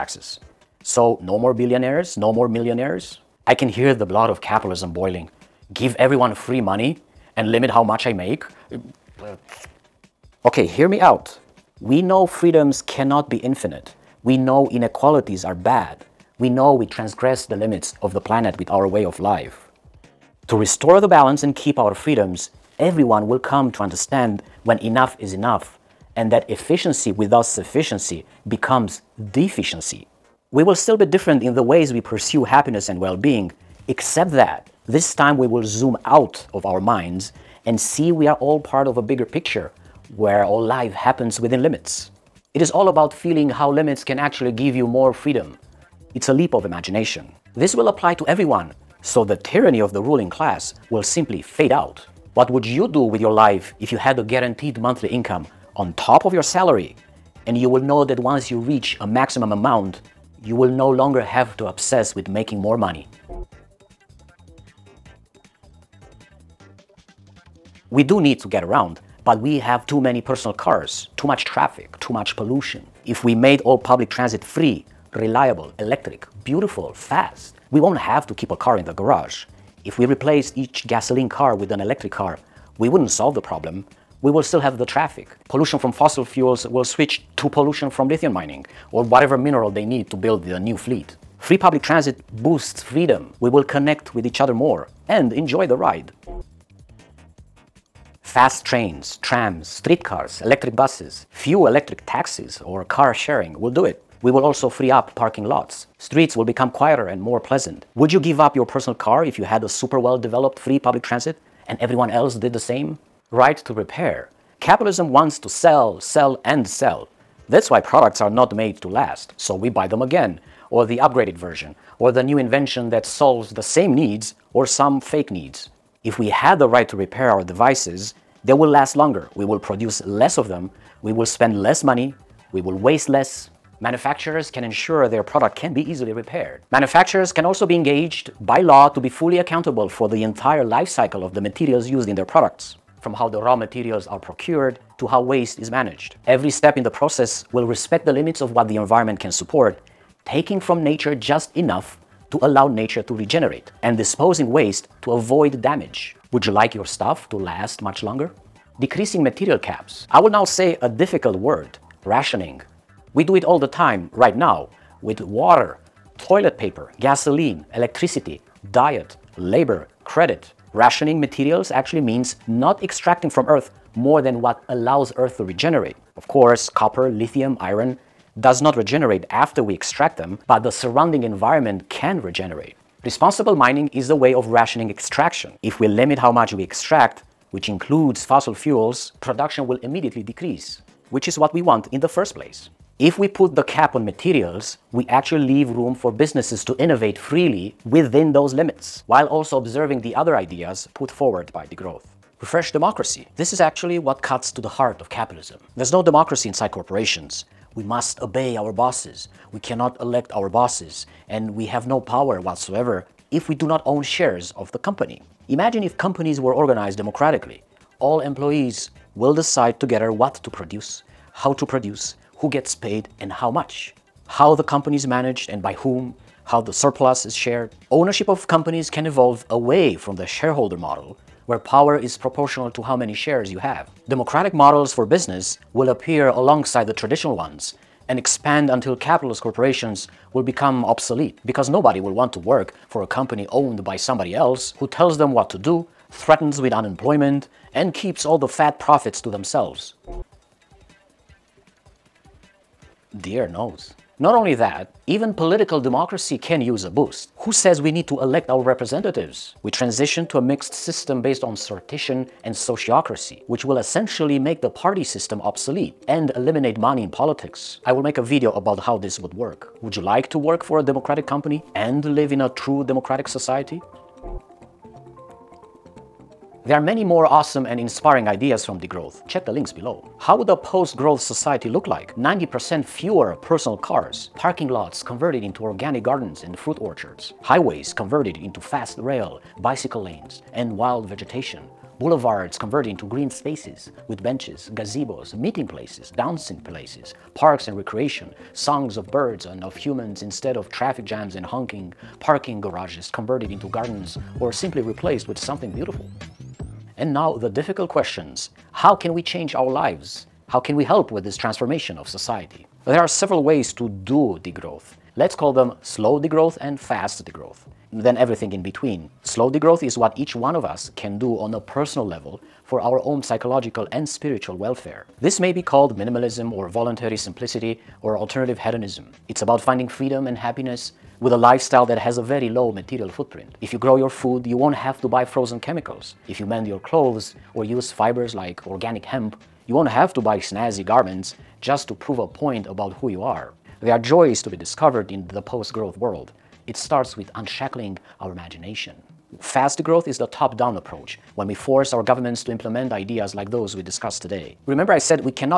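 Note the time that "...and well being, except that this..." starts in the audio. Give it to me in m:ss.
0:32.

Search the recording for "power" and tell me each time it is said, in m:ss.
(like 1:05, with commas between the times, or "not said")
3:31, 3:51.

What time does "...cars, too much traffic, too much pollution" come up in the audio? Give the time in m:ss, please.
1:10.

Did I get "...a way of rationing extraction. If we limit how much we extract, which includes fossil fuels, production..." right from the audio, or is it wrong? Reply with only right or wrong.
right.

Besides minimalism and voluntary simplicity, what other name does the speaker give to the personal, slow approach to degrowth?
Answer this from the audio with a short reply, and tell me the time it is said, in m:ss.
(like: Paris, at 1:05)
alternative hedonism, at 5:28.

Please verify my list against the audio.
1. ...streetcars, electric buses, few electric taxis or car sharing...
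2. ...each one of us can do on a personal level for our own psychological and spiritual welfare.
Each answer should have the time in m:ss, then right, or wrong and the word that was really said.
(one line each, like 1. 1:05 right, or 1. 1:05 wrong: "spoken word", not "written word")
1. 1:39 right
2. 5:20 right.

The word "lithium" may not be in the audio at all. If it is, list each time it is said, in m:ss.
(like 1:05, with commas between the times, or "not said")
1:28, 2:57.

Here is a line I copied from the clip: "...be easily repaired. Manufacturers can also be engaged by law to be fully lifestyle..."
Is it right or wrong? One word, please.
wrong.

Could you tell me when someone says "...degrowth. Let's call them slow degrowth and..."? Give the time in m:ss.
5:14.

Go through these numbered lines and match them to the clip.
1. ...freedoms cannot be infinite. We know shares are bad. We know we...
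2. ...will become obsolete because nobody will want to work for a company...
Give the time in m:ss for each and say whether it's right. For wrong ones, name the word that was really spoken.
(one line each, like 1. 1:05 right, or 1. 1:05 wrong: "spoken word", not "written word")
1. 0:12 wrong: "inequalities", not "shares"
2. 4:00 right.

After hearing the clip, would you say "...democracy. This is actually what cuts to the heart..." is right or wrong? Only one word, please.
right.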